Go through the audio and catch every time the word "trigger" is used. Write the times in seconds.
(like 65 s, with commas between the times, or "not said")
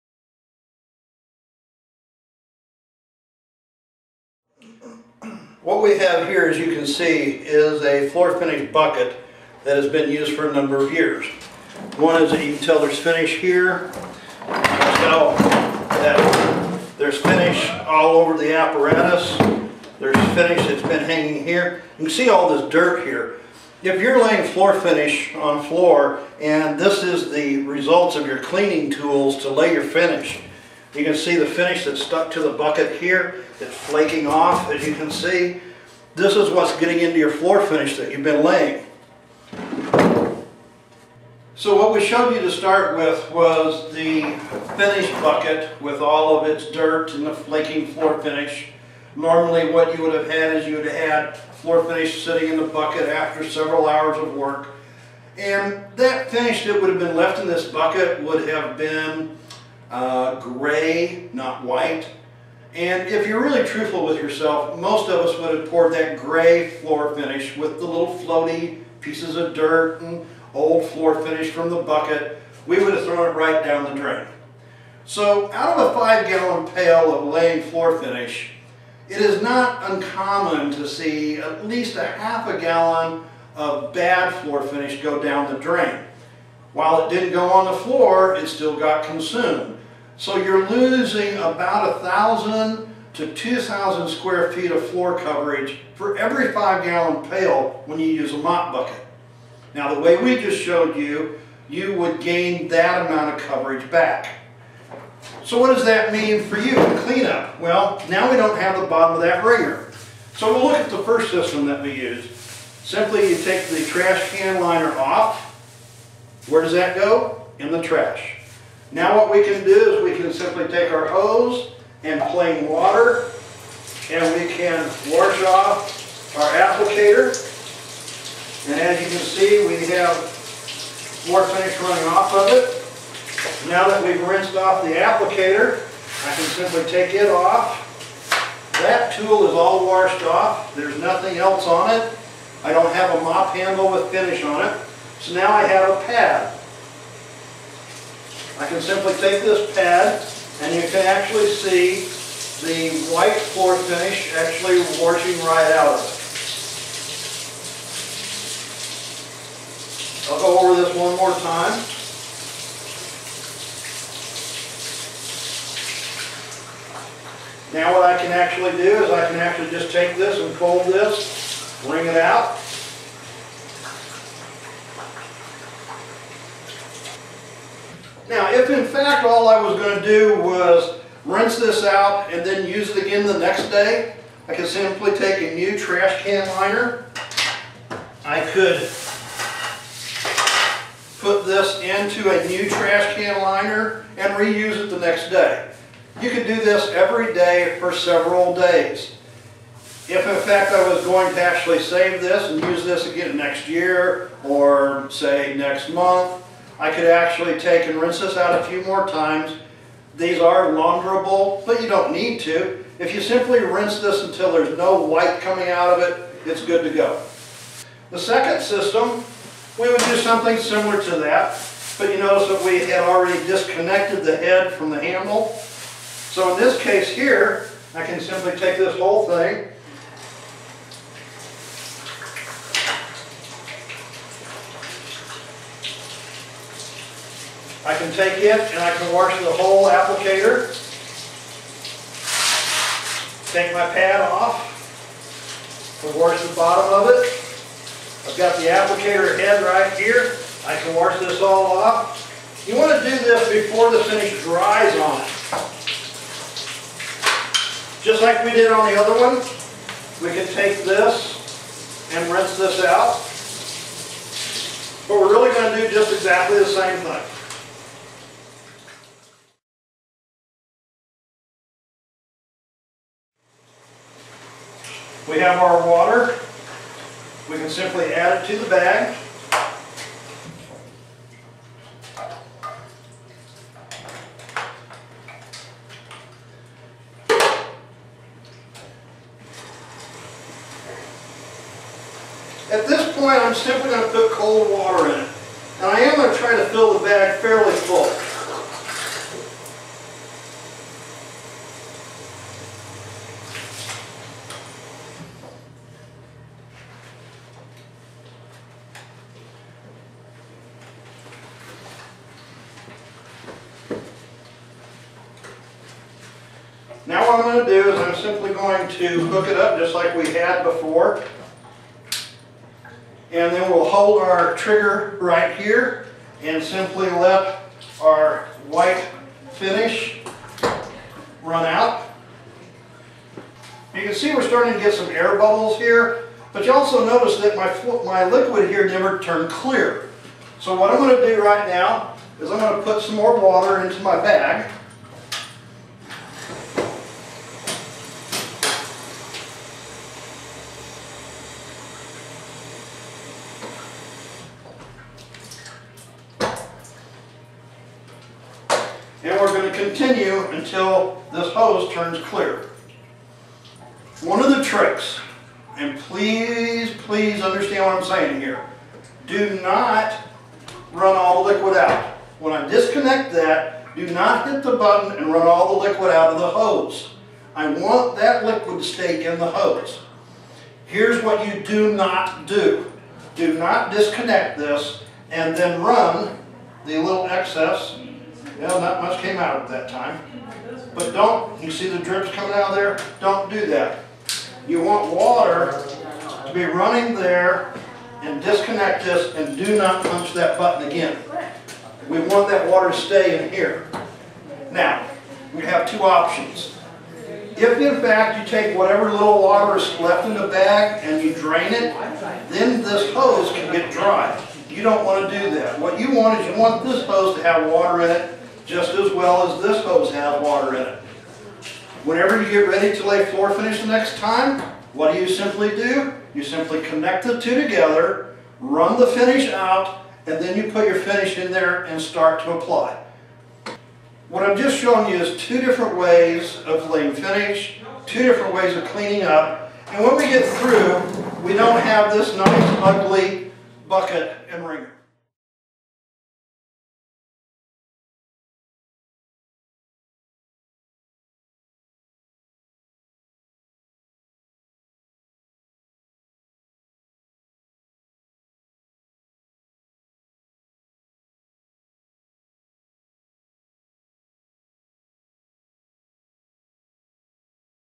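324 s.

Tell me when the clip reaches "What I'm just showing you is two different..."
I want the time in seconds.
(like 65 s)
434 s.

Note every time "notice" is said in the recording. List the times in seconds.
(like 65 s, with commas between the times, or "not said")
222 s, 337 s.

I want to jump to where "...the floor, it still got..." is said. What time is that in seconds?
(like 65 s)
87 s.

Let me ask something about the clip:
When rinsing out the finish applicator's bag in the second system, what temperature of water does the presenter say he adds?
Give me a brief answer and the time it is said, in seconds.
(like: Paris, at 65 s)
cold, at 294 s.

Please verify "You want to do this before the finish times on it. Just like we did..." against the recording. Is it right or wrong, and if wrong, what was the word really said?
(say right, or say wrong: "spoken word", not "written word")
wrong: "dries", not "times".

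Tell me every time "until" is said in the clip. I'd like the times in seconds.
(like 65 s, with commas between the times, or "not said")
214 s, 360 s.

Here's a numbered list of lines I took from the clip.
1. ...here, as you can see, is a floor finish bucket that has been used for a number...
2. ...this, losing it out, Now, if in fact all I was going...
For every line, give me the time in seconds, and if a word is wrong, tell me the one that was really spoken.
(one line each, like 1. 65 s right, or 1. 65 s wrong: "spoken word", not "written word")
1. 6 s right
2. 170 s wrong: "wring", not "losing".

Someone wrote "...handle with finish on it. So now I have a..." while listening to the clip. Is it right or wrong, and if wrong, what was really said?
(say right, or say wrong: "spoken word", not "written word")
right.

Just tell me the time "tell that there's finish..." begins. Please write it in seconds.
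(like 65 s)
14 s.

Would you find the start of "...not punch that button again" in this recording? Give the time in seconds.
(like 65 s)
399 s.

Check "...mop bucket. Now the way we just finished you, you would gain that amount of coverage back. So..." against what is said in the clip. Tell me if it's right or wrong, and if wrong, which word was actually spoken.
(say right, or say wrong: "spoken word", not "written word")
wrong: "showed", not "finished".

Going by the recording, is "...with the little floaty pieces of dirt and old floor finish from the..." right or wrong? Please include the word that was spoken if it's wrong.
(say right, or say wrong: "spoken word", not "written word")
right.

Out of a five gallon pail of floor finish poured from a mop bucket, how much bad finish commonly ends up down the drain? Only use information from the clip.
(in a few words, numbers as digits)
half a gallon.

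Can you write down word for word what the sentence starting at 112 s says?
Simply you take the trash can liner off.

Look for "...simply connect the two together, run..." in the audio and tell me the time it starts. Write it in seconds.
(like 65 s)
426 s.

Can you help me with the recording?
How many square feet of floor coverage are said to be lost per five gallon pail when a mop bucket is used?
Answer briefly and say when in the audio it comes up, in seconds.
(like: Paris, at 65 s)
1,000 to 2,000, at 91 s.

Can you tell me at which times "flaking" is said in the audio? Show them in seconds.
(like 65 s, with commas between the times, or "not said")
33 s, 47 s.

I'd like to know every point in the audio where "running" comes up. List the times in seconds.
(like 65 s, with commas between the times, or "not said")
131 s, 396 s.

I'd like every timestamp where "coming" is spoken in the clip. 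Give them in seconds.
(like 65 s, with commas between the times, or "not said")
215 s, 392 s.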